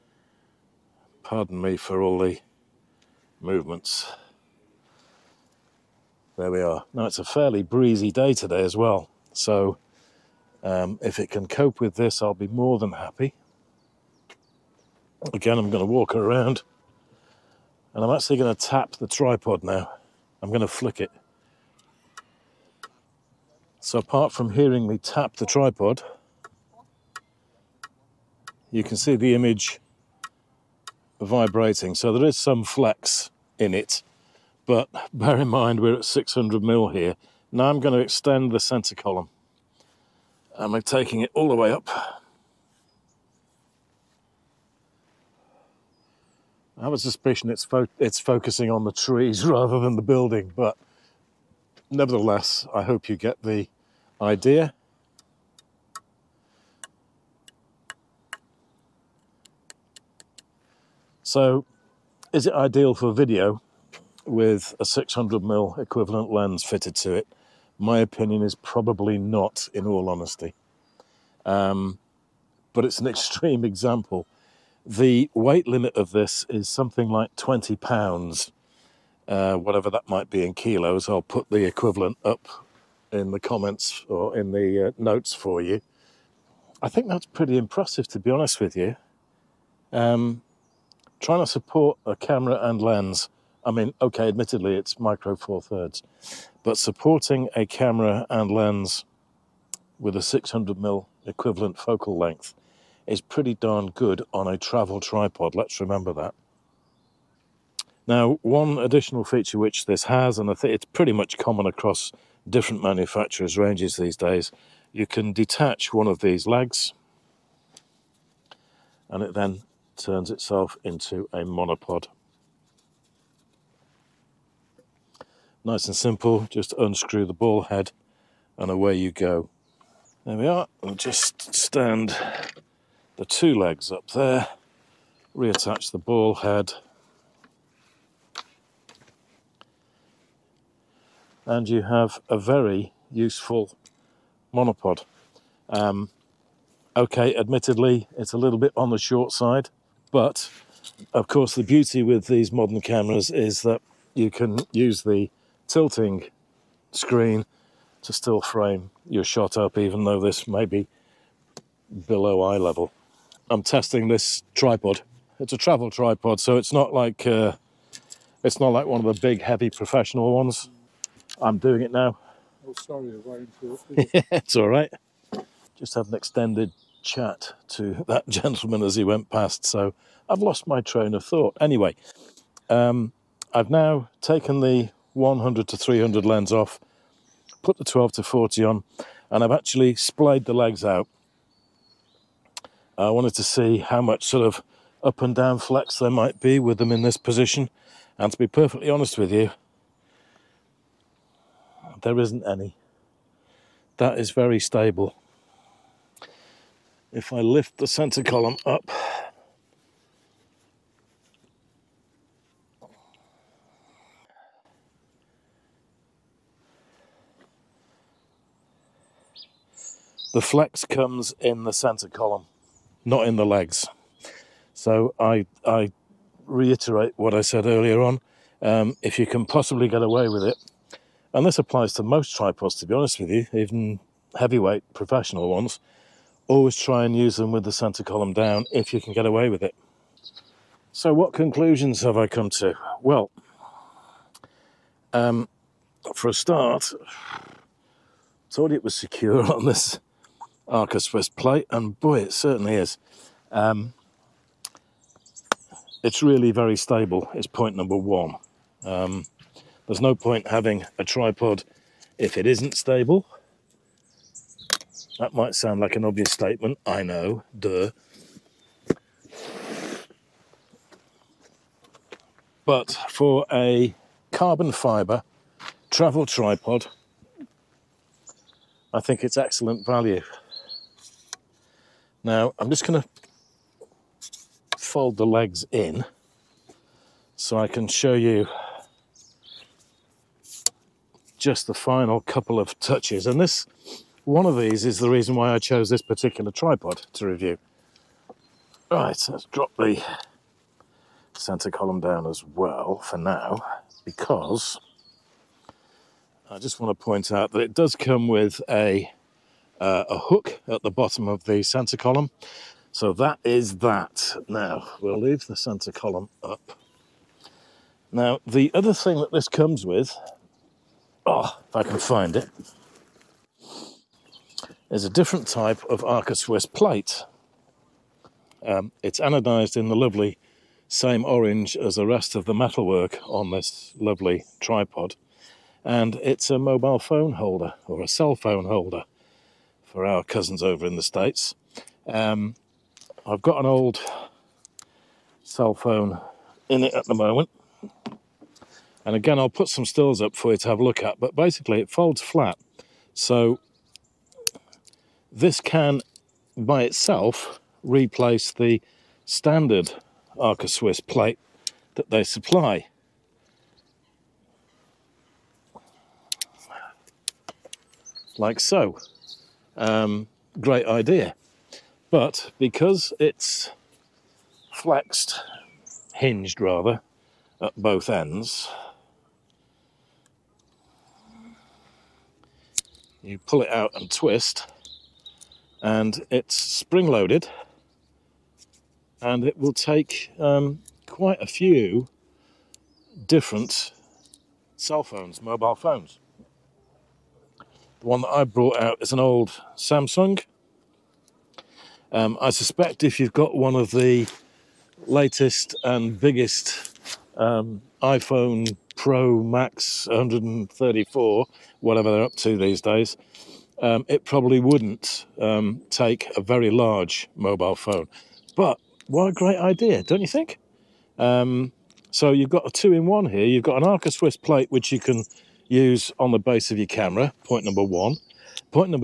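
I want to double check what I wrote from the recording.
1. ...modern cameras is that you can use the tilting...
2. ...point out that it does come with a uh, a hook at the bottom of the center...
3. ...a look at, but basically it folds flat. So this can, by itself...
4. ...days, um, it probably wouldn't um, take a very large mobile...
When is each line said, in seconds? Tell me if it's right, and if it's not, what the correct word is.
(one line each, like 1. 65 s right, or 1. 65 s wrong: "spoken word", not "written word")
1. 152 s right
2. 307 s right
3. 350 s right
4. 412 s right.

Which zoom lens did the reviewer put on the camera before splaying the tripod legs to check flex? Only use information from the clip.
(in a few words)
12 to 40.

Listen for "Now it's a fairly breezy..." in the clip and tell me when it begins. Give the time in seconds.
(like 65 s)
6 s.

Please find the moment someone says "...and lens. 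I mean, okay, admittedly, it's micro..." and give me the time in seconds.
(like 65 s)
92 s.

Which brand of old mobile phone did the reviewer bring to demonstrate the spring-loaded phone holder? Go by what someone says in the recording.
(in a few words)
Samsung.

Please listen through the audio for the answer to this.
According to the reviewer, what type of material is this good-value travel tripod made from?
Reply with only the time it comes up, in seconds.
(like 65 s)
274 s.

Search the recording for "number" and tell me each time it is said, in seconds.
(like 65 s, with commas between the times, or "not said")
257 s, 427 s.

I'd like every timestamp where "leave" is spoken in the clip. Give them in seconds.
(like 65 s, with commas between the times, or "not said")
315 s.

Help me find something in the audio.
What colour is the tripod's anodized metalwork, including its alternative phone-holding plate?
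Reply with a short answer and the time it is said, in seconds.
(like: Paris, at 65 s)
Orange, at 331 s.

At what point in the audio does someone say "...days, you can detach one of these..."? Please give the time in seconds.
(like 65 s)
114 s.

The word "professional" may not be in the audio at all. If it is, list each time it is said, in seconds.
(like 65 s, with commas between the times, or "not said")
169 s, 234 s.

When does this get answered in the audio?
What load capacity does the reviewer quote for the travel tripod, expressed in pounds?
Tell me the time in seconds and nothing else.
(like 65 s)
77 s.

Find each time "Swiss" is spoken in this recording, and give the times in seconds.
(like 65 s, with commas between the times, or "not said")
251 s, 326 s, 360 s, 424 s.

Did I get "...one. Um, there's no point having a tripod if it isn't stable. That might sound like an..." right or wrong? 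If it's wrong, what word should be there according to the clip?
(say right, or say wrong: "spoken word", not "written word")
right.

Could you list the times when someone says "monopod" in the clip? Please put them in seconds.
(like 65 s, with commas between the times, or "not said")
121 s, 144 s.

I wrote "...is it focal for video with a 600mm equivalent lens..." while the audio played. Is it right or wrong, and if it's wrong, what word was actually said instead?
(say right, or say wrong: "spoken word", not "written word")
wrong: "ideal", not "focal".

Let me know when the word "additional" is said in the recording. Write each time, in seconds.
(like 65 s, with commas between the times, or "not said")
108 s.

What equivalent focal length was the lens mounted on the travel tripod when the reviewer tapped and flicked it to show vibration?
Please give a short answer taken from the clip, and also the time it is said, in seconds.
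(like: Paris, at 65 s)
600mm, at 36 s.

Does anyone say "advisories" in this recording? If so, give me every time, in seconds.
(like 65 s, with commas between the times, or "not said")
not said.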